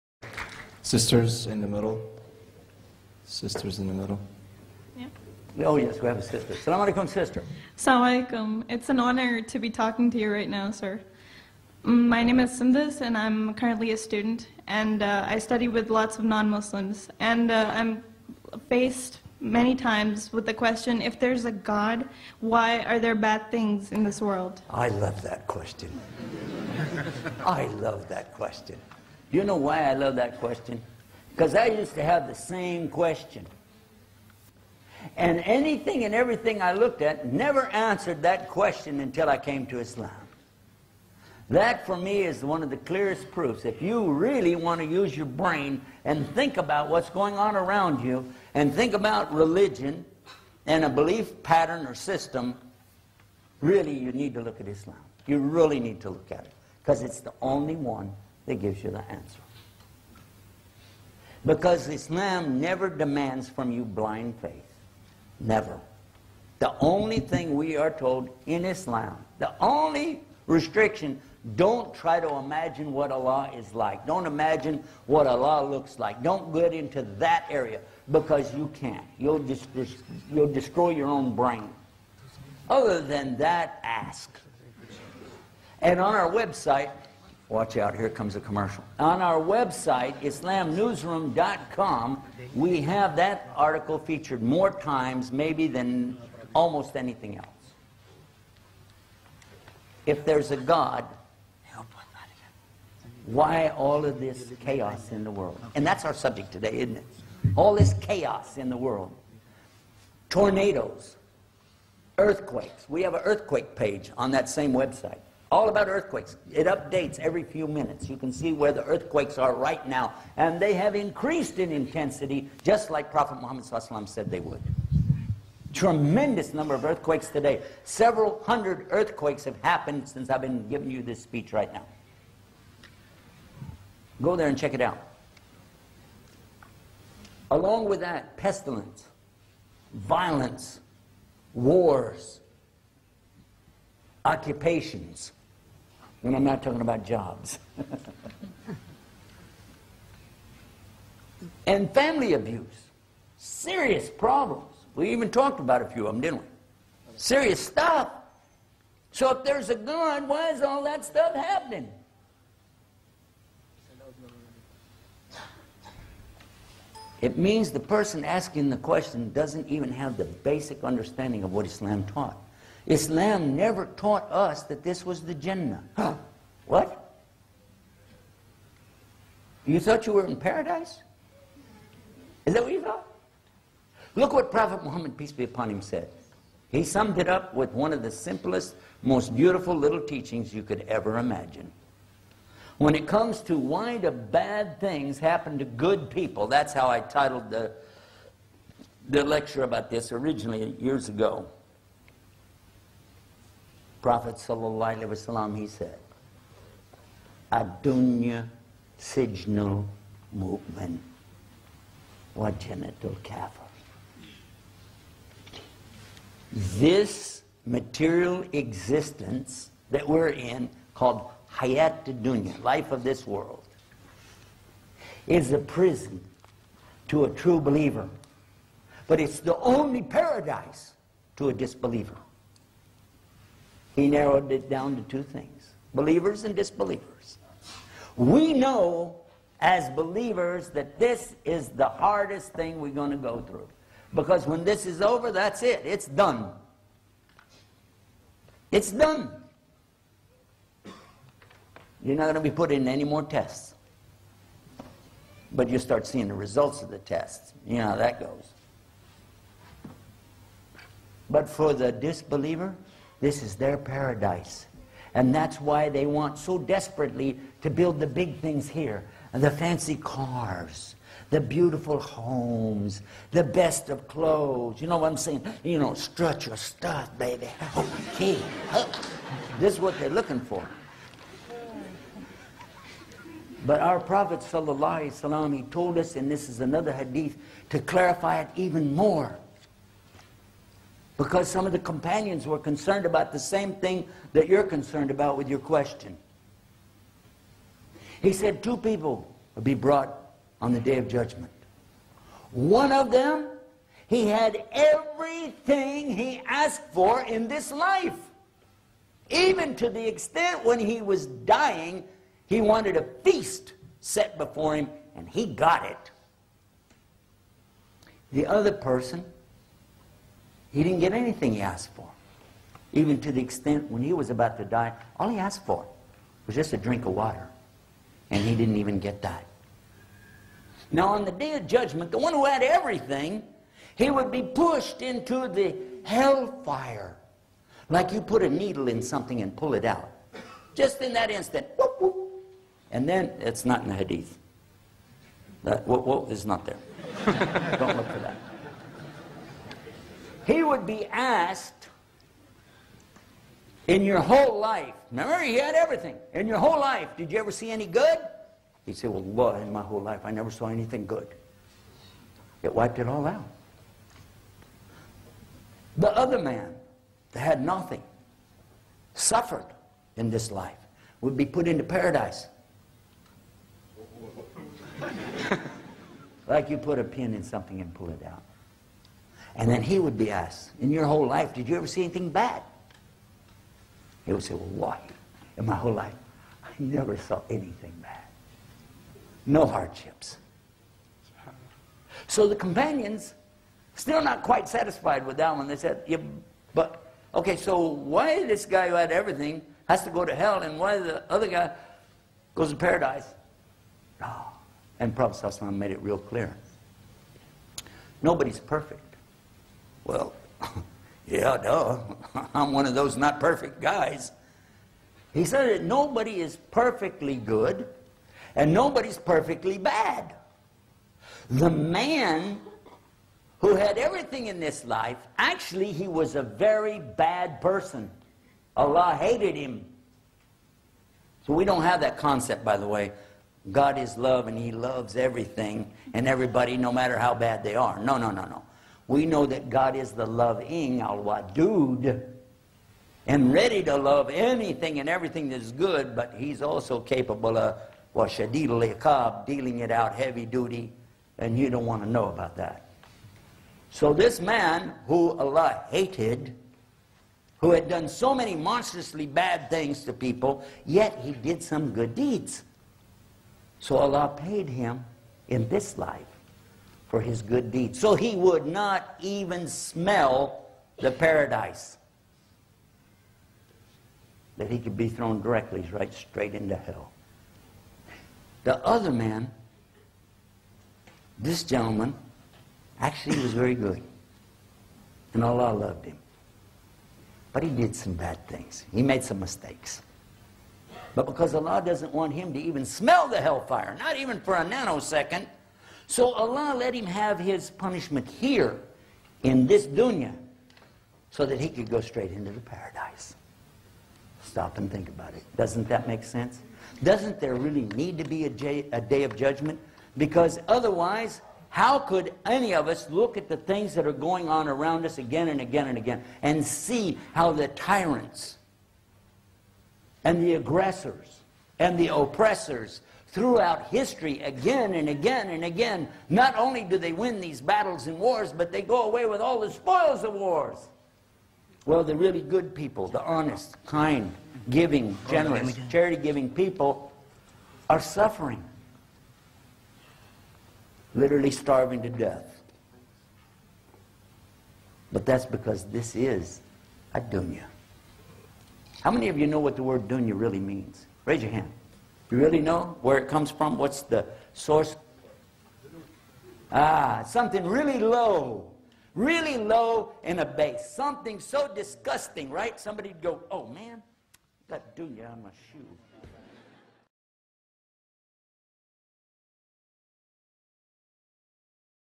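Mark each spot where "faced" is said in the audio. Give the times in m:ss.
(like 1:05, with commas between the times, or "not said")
0:18.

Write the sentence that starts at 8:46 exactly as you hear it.
Not only do they win these battles and wars, but they go away with all the spoils of wars.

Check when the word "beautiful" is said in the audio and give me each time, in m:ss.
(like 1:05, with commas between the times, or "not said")
3:09, 4:31.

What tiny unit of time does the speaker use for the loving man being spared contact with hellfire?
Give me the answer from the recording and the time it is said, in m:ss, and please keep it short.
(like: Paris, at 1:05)
A nanosecond, at 8:14.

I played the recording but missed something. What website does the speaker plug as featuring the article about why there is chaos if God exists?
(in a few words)
islamnewsroom.com.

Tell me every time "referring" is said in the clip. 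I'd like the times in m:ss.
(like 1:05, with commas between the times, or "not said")
not said.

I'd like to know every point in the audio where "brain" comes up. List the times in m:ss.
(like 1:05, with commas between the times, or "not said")
0:45, 1:21.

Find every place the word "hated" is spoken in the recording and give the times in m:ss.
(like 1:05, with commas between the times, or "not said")
7:09, 7:35.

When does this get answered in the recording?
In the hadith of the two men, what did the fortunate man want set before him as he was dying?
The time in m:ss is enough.
5:12.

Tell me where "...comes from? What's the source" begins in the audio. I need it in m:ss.
9:13.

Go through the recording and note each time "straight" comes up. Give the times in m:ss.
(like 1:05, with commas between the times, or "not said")
7:56, 8:22.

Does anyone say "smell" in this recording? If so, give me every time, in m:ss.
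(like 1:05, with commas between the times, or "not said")
7:49, 8:12.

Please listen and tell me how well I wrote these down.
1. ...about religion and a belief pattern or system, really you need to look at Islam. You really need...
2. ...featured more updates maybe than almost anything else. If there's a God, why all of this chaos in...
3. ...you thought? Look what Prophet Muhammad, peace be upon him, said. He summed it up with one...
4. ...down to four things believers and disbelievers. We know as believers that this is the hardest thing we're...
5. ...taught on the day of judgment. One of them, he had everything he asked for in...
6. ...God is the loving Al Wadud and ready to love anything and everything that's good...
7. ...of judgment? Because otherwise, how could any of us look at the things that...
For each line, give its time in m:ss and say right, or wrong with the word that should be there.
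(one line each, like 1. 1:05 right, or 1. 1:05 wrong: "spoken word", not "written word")
1. 0:48 right
2. 1:33 wrong: "times", not "updates"
3. 3:02 right
4. 3:54 wrong: "two", not "four"
5. 4:59 wrong: "brought", not "taught"
6. 7:19 right
7. 8:29 right.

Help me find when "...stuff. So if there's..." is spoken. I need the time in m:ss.
2:37.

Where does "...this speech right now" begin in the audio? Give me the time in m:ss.
2:11.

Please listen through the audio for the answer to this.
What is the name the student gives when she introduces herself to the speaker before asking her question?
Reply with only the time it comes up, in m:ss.
0:12.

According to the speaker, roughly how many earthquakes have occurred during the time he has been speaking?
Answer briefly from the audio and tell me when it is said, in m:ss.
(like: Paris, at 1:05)
Several hundred, at 2:07.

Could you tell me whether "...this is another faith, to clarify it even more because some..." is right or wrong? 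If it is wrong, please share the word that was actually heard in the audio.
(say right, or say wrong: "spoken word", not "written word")
wrong: "hadith", not "faith".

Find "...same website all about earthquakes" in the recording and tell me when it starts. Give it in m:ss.
1:54.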